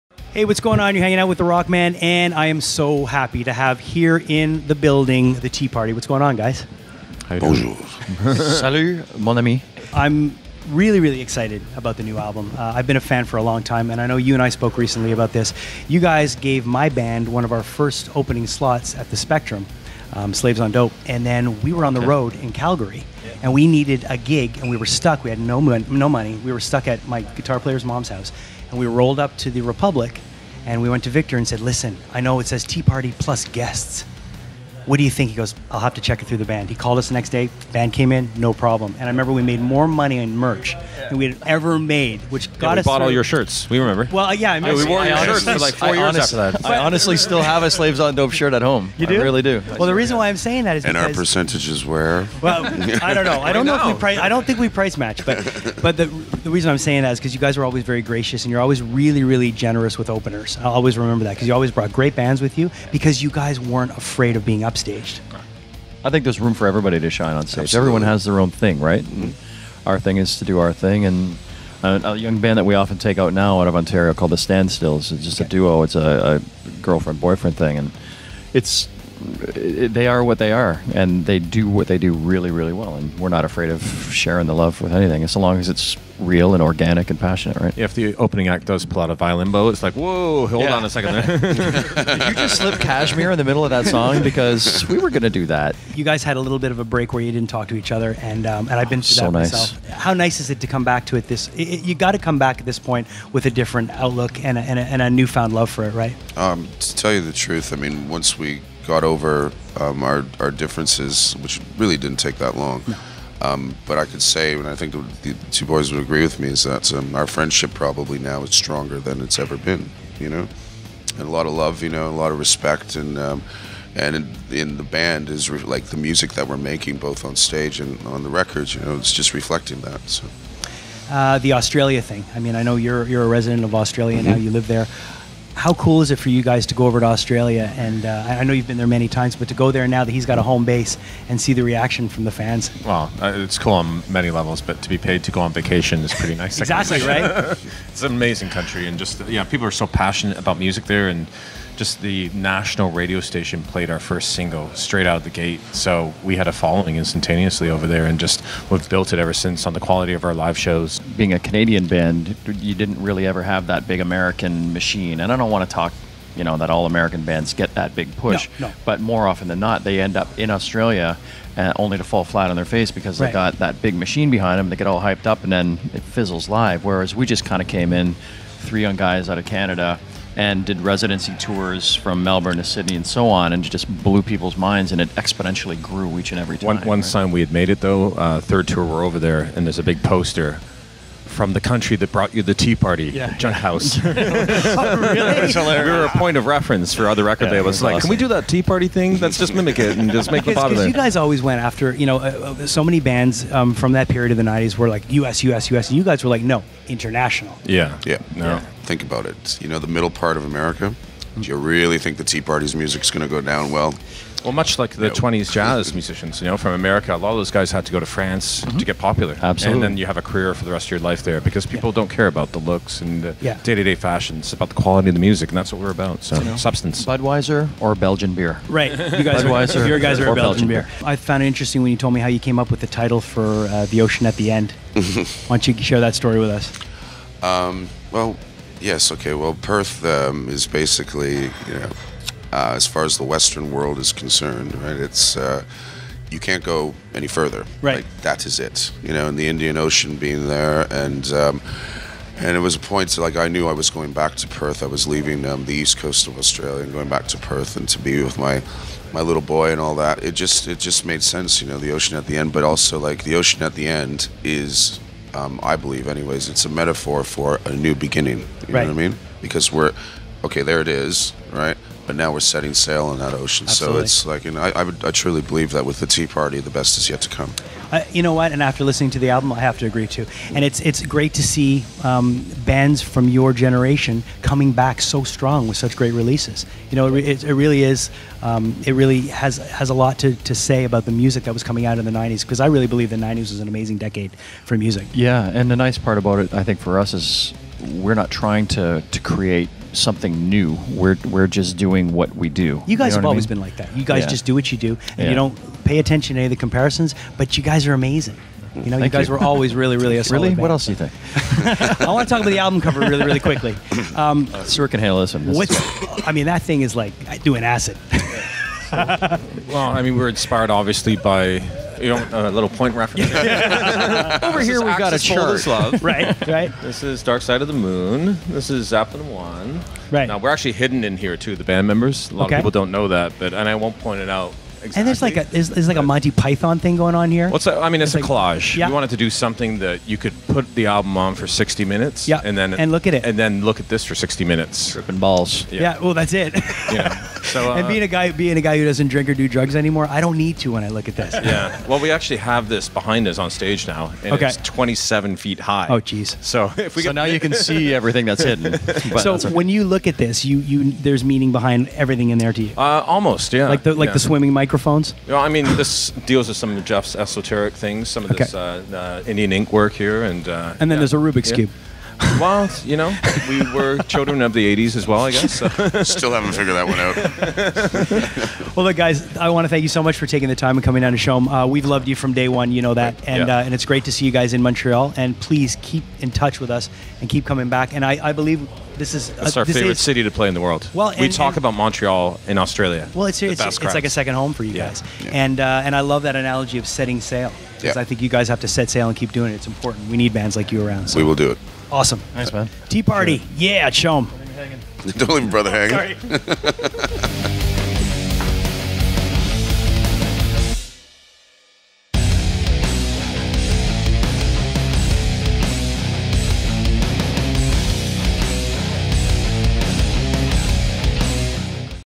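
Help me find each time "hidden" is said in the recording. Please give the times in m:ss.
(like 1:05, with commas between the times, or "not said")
5:30, 5:58.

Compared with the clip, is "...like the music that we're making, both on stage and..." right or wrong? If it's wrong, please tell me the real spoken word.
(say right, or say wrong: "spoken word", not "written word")
right.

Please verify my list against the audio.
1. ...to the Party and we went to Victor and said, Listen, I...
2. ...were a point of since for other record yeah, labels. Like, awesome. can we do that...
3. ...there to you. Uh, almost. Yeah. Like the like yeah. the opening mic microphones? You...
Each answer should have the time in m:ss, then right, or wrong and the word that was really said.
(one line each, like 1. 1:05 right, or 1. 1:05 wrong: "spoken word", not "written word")
1. 0:29 wrong: "Republic", not "Party"
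2. 3:15 wrong: "reference", not "since"
3. 6:02 wrong: "swimming", not "opening".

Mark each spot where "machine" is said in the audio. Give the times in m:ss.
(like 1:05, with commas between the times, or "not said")
2:44, 2:53.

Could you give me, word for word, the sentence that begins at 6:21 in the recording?
Uh, we've loved you from day one, you know that.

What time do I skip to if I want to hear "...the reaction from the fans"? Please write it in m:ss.
2:21.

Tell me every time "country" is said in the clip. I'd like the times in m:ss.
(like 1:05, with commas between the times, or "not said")
2:28, 3:11.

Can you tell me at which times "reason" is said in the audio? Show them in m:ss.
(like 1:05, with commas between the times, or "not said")
0:49, 0:56.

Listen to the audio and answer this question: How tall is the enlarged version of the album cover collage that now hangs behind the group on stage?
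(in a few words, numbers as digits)
27 feet.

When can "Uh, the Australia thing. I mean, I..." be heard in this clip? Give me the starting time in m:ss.
2:11.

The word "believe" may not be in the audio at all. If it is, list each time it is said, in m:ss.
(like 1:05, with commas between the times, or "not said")
4:25, 4:35, 4:52, 6:28.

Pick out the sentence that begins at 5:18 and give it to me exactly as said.
so, well, I mean, we're inspired obviously by you know, a uh, little point reference?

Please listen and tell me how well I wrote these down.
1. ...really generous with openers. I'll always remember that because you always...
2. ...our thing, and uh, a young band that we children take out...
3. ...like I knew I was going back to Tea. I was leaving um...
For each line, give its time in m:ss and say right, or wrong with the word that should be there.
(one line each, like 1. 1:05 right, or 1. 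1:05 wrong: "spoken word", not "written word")
1. 0:59 right
2. 1:10 wrong: "often", not "children"
3. 4:13 wrong: "Perth", not "Tea".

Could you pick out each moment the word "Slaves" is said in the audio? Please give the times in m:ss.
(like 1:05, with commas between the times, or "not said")
0:20, 0:47.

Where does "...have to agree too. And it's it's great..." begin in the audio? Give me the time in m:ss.
4:39.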